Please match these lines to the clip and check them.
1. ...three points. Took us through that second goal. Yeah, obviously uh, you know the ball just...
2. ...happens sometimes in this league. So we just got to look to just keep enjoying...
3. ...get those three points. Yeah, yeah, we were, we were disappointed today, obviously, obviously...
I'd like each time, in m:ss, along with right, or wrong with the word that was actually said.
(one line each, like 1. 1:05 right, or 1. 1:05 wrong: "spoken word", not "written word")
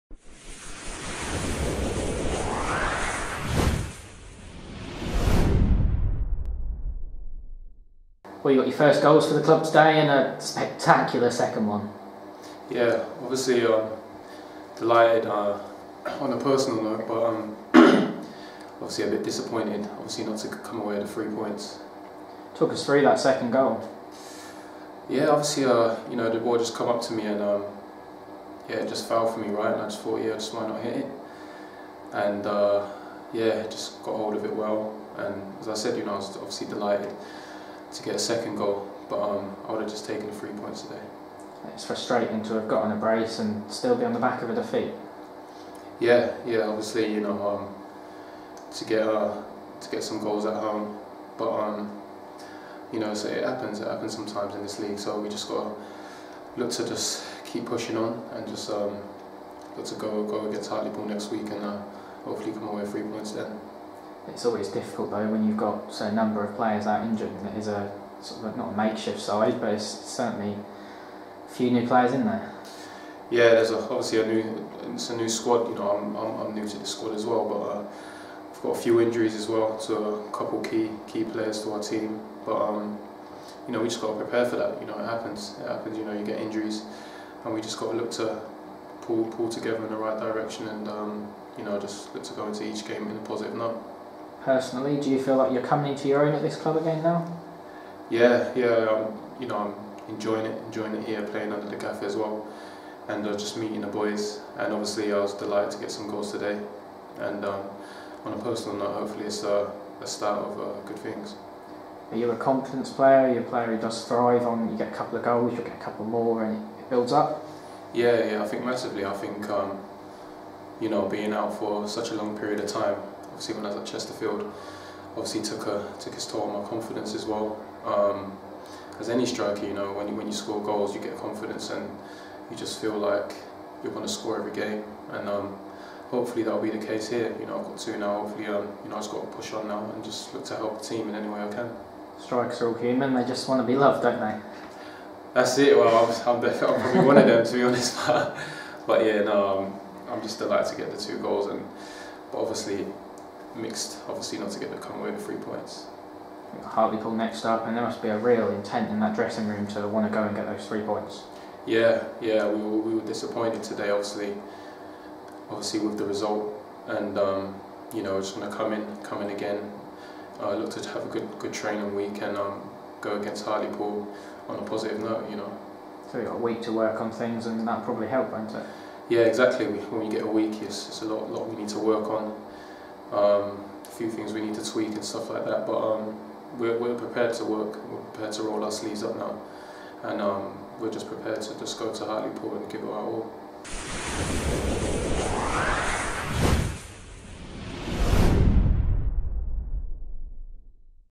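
1. 0:21 right
2. 0:53 wrong: "pushing", not "enjoying"
3. 2:40 right.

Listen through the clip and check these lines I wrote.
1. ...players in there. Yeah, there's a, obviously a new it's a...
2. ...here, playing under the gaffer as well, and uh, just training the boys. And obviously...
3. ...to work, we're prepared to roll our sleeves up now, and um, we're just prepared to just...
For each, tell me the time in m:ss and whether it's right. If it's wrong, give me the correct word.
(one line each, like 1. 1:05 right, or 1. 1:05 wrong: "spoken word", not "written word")
1. 1:11 right
2. 1:41 wrong: "meeting", not "training"
3. 3:07 right.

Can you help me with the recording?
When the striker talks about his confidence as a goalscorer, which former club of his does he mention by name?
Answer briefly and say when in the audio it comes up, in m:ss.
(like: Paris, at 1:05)
Chesterfield, at 2:03.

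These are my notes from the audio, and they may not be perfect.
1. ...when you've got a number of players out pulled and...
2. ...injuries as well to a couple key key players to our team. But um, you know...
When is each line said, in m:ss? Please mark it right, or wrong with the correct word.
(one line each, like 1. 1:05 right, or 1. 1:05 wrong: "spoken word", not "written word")
1. 1:05 wrong: "injured", not "pulled"
2. 1:18 right.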